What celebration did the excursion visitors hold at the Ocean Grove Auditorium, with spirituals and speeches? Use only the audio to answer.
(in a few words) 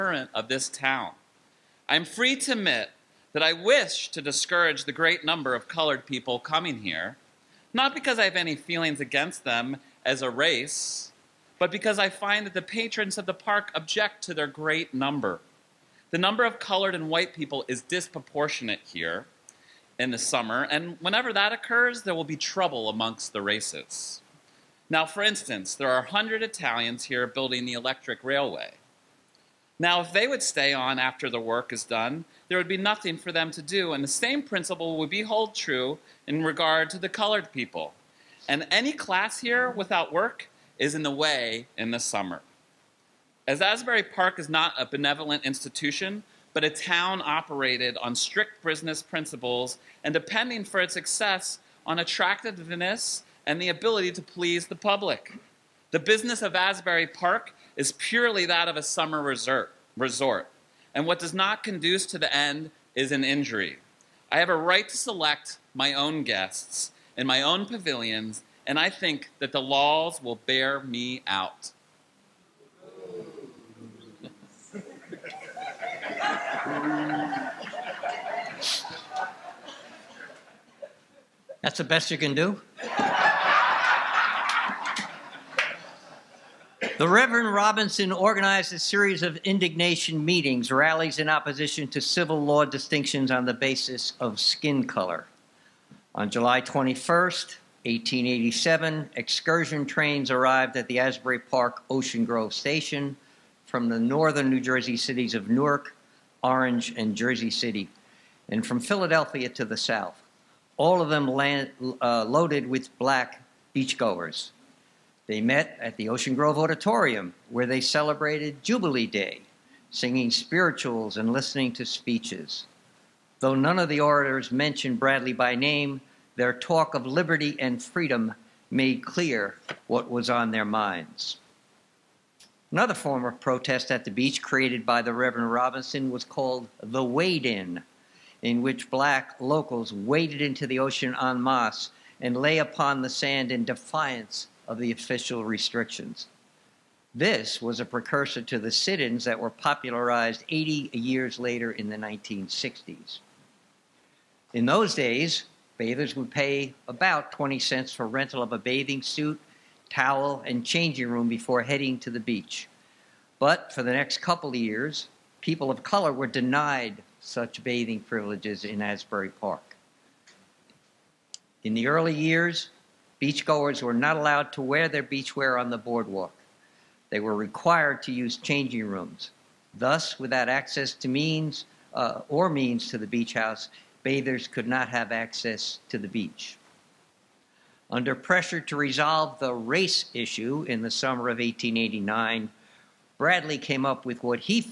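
Jubilee Day.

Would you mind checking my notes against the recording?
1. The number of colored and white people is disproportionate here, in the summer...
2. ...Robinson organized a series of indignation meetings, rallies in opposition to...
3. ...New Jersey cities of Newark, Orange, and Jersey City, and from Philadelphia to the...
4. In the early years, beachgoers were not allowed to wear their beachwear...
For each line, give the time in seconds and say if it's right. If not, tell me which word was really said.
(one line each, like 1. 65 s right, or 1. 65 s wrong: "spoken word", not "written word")
1. 16 s right
2. 87 s right
3. 104 s right
4. 171 s right.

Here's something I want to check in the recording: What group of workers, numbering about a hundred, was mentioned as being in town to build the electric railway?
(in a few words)
Italians.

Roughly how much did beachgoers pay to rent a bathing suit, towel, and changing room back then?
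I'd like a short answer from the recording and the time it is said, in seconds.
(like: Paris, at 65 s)
20 cents, at 157 s.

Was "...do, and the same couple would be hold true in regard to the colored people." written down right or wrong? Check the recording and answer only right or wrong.
wrong.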